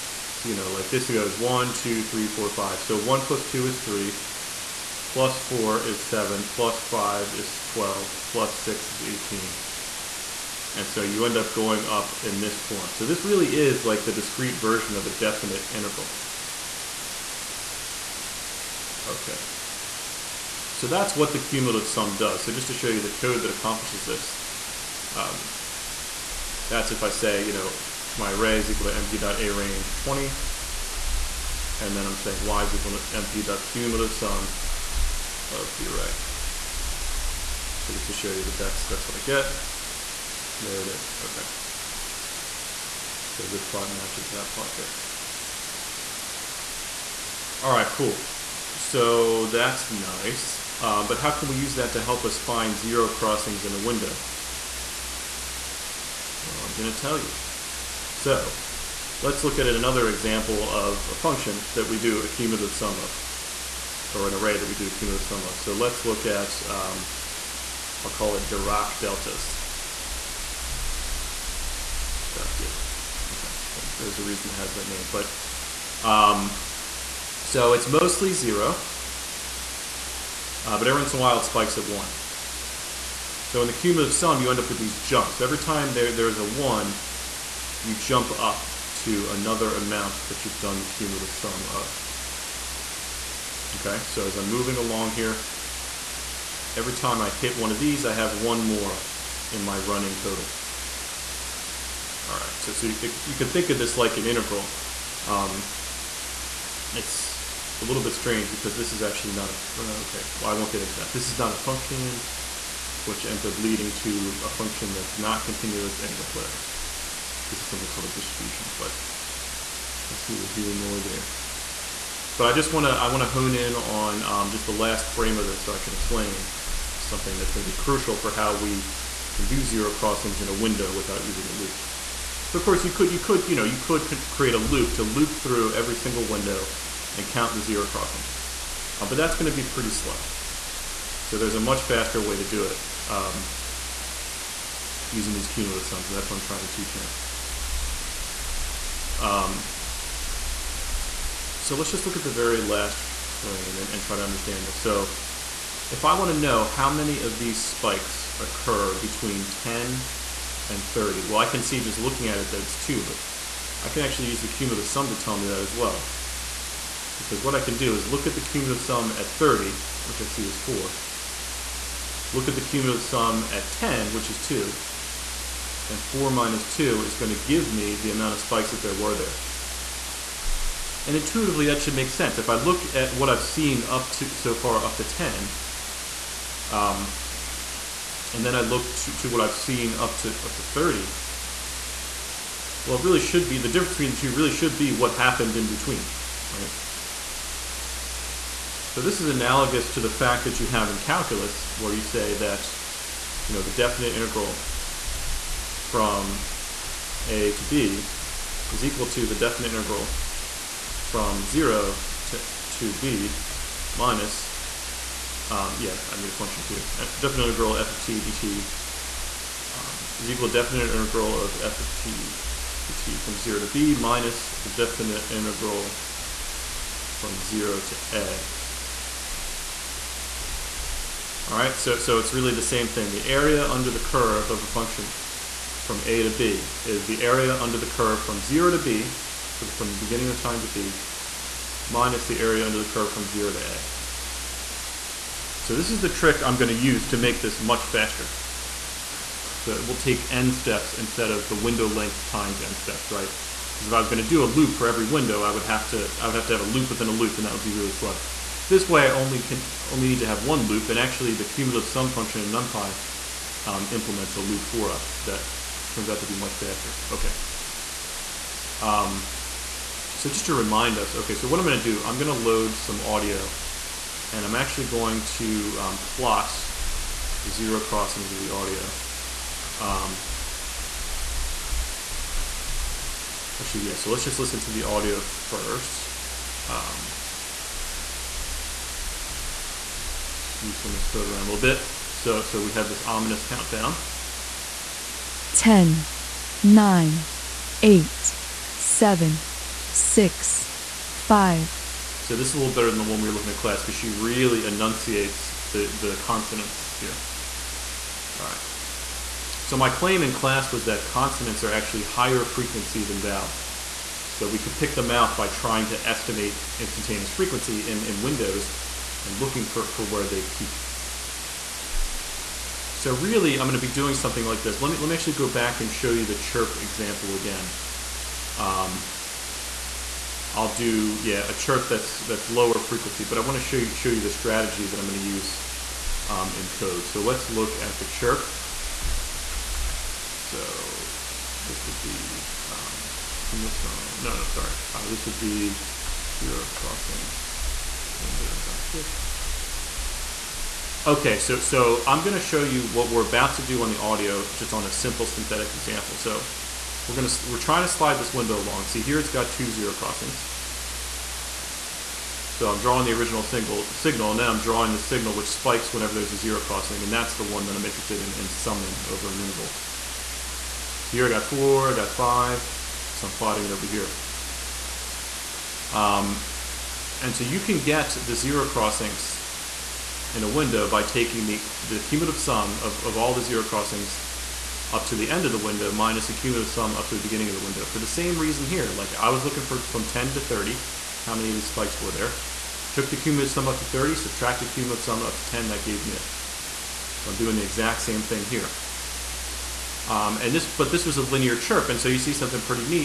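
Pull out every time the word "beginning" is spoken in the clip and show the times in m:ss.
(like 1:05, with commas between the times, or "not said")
3:59, 6:27.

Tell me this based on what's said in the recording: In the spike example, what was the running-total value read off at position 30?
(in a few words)
4.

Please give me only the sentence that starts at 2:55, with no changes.
And 4 minus 2 is going to give me the amount of spikes that there were there.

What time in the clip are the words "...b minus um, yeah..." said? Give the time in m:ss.
3:32.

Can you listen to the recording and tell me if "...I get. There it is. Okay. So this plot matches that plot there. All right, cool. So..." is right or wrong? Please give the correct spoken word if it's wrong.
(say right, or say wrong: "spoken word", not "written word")
right.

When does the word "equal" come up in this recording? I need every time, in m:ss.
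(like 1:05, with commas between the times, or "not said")
0:28, 0:32, 3:28, 3:40.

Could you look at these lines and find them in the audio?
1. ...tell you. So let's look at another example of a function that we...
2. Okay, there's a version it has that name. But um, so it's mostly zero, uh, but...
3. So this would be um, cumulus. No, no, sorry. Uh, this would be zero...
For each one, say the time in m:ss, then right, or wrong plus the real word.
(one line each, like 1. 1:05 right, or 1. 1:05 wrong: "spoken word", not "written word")
1. 0:56 right
2. 1:13 wrong: "reason", not "version"
3. 5:40 right.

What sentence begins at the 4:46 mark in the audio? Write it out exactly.
Um, move some of this code around a little bit.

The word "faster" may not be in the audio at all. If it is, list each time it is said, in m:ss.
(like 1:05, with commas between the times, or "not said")
2:21, 4:07, 4:26.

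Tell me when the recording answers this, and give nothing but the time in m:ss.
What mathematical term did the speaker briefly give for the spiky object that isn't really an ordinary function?
1:58.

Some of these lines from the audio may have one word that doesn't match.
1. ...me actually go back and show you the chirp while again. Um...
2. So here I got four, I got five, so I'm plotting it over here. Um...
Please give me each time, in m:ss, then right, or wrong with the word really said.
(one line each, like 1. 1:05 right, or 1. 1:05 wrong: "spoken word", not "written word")
1. 5:25 wrong: "example", not "while"
2. 6:11 right.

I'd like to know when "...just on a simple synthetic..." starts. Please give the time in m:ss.
5:54.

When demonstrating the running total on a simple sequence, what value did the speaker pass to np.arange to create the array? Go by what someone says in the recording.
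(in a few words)
20.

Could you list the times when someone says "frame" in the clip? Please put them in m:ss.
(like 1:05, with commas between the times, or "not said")
2:05, 2:33.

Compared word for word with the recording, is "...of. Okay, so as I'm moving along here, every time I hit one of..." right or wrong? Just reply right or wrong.
right.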